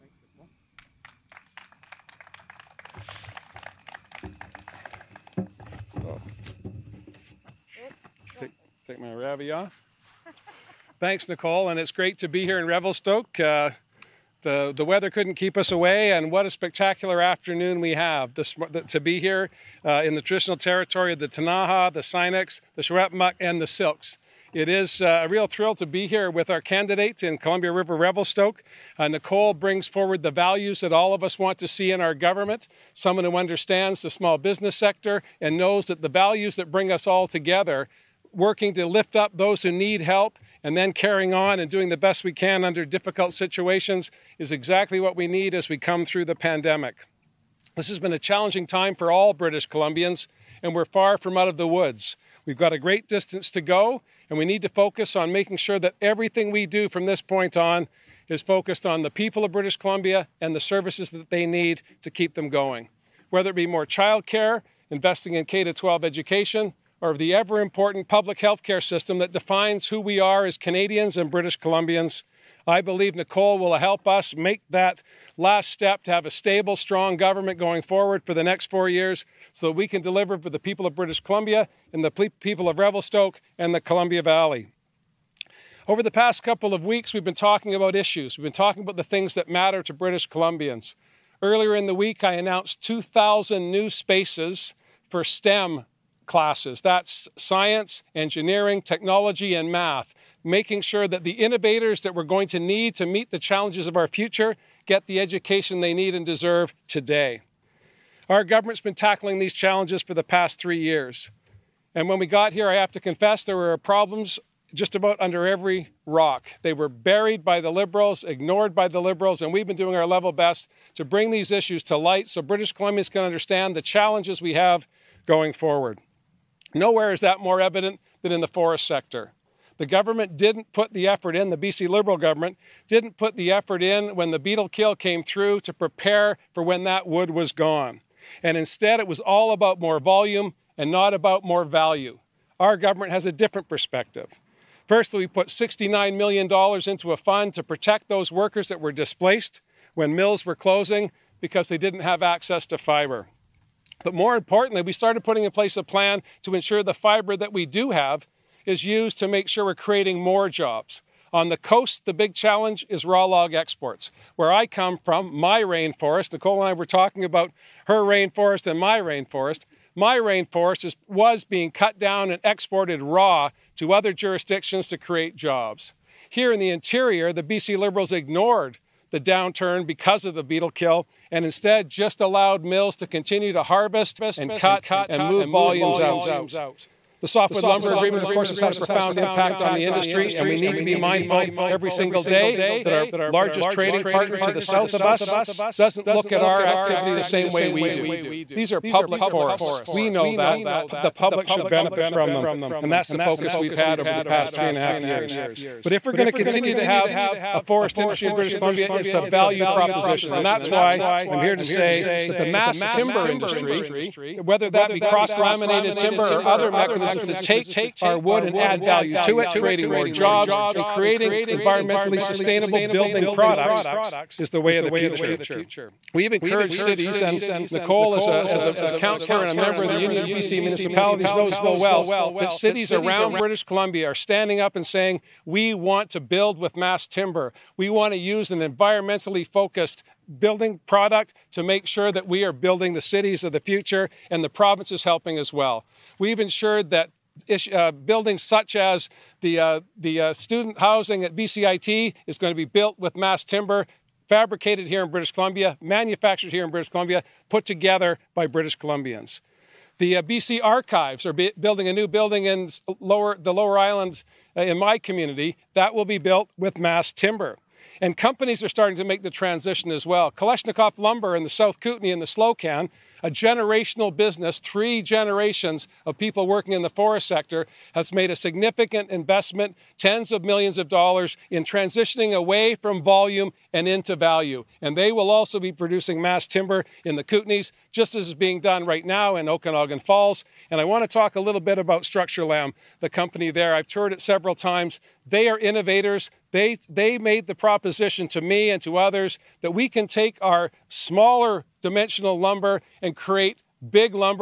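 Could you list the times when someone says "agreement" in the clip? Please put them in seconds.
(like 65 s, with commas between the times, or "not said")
187 s.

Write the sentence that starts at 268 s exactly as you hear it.
And companies are starting to make the transition as well.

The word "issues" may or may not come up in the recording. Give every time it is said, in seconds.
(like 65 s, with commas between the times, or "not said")
87 s, 121 s.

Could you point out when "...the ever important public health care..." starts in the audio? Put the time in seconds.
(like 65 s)
67 s.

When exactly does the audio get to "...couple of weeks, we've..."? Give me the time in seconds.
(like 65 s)
86 s.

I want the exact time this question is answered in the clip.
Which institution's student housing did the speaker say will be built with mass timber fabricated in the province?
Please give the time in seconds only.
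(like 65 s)
251 s.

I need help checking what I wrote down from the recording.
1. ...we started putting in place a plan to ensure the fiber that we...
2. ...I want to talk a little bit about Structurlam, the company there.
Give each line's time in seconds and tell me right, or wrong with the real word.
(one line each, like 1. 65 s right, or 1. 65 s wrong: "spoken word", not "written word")
1. 154 s right
2. 290 s right.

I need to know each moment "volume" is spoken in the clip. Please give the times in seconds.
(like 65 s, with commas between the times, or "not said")
140 s, 185 s, 283 s.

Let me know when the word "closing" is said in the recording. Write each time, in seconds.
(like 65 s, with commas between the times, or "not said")
150 s.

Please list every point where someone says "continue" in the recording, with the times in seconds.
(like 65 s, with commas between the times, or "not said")
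183 s, 206 s.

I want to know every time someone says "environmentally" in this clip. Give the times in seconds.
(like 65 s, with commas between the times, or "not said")
221 s, 238 s.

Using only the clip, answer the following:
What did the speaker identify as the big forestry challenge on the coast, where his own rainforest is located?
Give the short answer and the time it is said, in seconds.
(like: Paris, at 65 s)
Raw log exports, at 163 s.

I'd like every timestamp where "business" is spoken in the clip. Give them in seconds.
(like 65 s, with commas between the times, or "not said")
34 s, 274 s.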